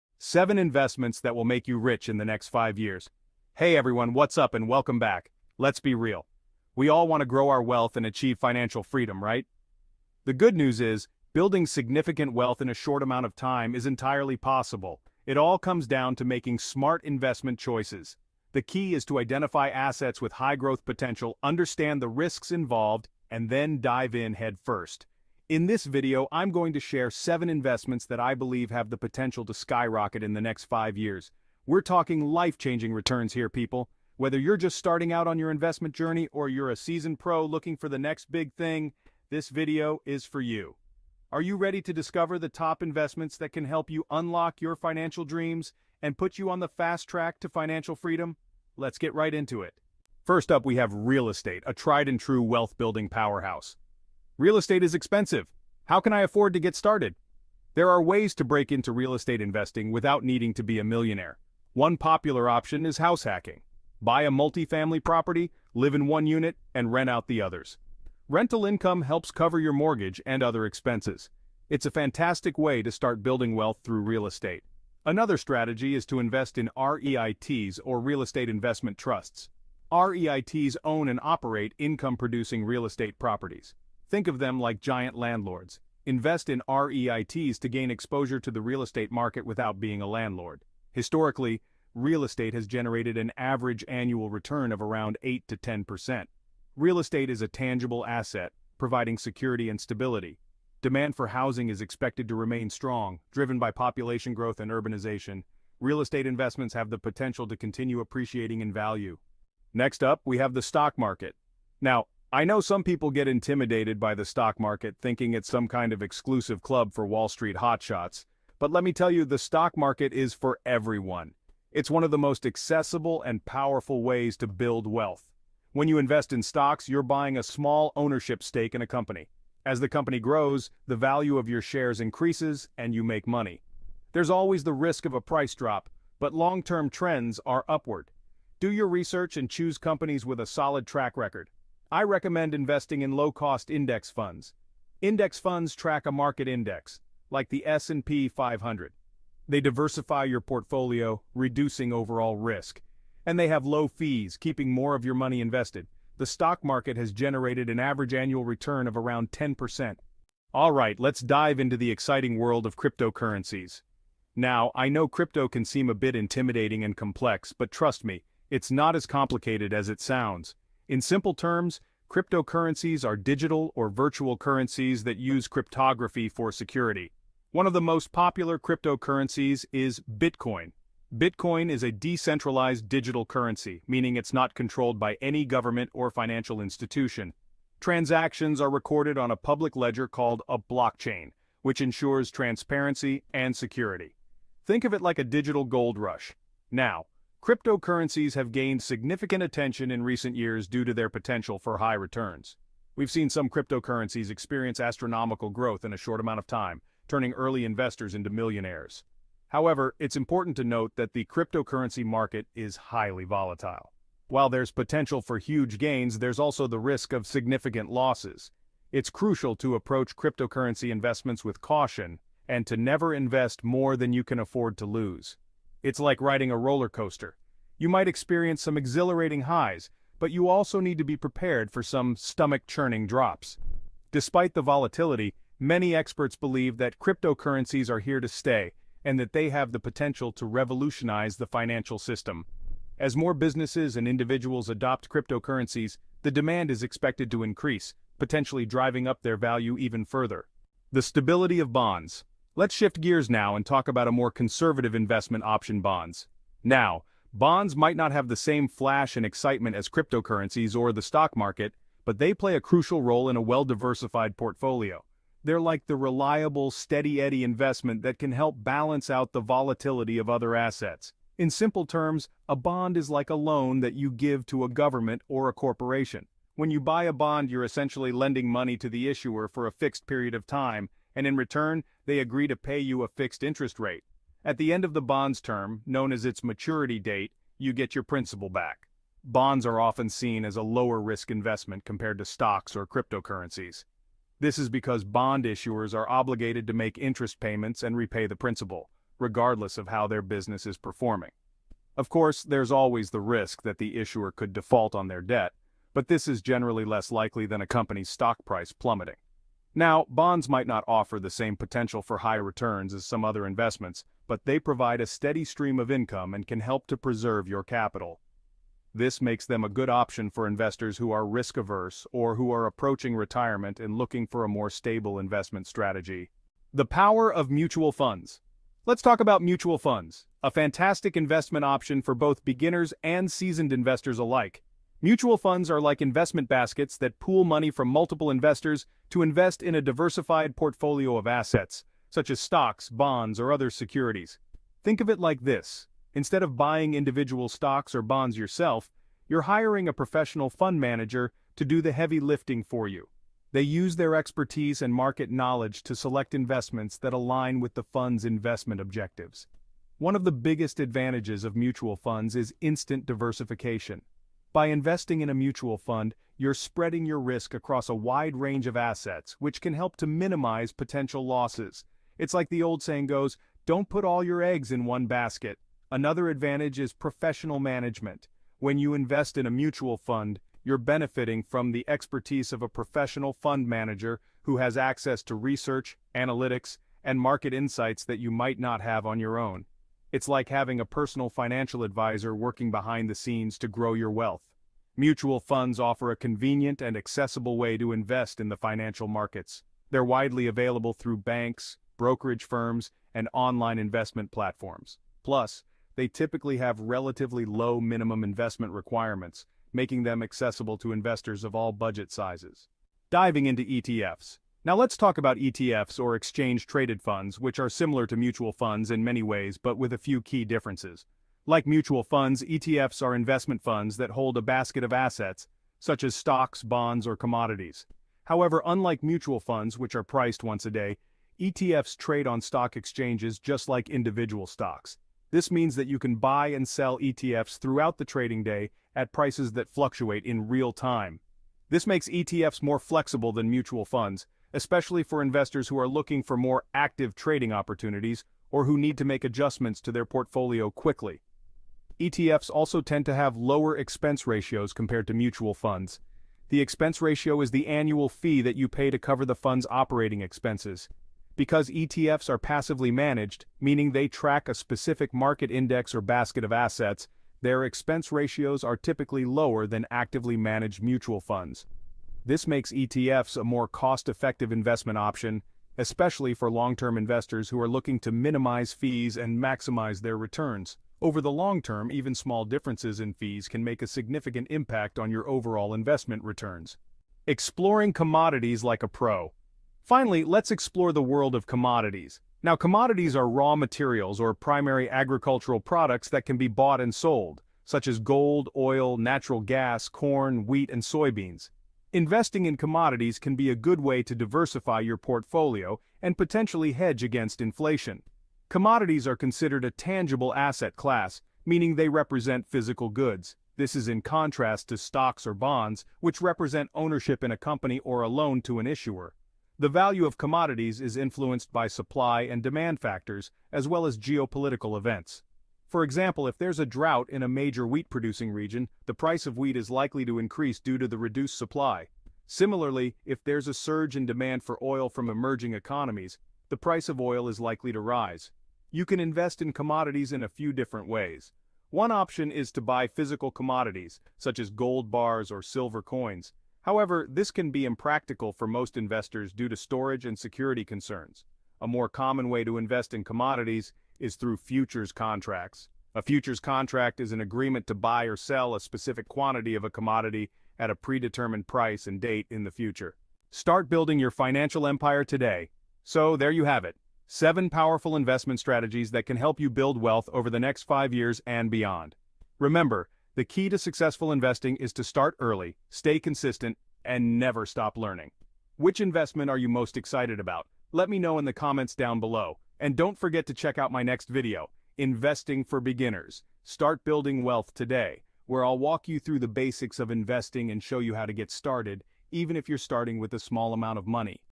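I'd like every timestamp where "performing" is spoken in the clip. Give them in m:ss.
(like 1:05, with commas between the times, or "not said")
5:00.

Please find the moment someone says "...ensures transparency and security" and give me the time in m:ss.
3:11.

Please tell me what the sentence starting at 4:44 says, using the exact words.
At the end of the bond's term, known as its maturity date, you get your principal back.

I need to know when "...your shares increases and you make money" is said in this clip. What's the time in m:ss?
2:11.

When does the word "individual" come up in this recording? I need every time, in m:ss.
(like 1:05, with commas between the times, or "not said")
4:04, 5:46, 7:13.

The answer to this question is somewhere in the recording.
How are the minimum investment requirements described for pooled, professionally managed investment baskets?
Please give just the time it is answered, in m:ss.
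6:46.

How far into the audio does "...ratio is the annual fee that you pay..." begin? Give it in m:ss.
7:37.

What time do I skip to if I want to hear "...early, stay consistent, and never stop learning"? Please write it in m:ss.
9:35.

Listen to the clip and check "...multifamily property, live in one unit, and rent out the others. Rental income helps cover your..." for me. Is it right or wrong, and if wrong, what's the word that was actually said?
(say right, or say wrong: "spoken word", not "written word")
right.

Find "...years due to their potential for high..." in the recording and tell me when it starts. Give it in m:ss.
3:20.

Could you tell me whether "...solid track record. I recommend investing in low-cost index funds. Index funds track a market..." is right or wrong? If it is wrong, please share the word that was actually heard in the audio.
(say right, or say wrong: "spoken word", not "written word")
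right.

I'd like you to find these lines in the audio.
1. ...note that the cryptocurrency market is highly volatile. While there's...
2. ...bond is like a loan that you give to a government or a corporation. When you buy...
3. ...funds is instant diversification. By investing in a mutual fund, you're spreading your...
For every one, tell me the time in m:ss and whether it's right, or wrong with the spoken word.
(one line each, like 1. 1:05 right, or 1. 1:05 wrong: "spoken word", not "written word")
1. 3:30 right
2. 4:32 right
3. 6:01 right.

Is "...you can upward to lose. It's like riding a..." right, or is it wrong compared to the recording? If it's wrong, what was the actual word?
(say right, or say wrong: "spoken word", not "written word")
wrong: "afford", not "upward".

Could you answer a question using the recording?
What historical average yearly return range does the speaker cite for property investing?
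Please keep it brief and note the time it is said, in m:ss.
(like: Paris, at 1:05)
8 to 10%, at 1:35.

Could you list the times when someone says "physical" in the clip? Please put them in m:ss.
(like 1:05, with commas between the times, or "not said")
8:32, 9:02.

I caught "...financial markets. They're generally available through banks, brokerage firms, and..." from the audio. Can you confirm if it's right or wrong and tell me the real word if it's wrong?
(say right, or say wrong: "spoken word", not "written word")
wrong: "widely", not "generally".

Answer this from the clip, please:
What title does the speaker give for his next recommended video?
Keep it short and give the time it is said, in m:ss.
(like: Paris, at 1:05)
Investing for Beginners, at 9:44.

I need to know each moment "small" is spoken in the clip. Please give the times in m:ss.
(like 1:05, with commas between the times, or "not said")
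2:07, 8:02, 9:53.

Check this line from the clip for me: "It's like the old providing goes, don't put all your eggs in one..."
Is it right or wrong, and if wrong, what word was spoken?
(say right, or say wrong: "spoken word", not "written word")
wrong: "saying", not "providing".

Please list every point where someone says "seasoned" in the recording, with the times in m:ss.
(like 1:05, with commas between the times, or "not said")
0:36, 5:33.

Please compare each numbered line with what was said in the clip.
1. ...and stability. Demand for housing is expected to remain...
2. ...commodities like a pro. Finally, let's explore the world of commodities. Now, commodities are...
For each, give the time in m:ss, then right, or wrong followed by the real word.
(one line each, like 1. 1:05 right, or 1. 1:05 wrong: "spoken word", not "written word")
1. 1:39 right
2. 8:07 right.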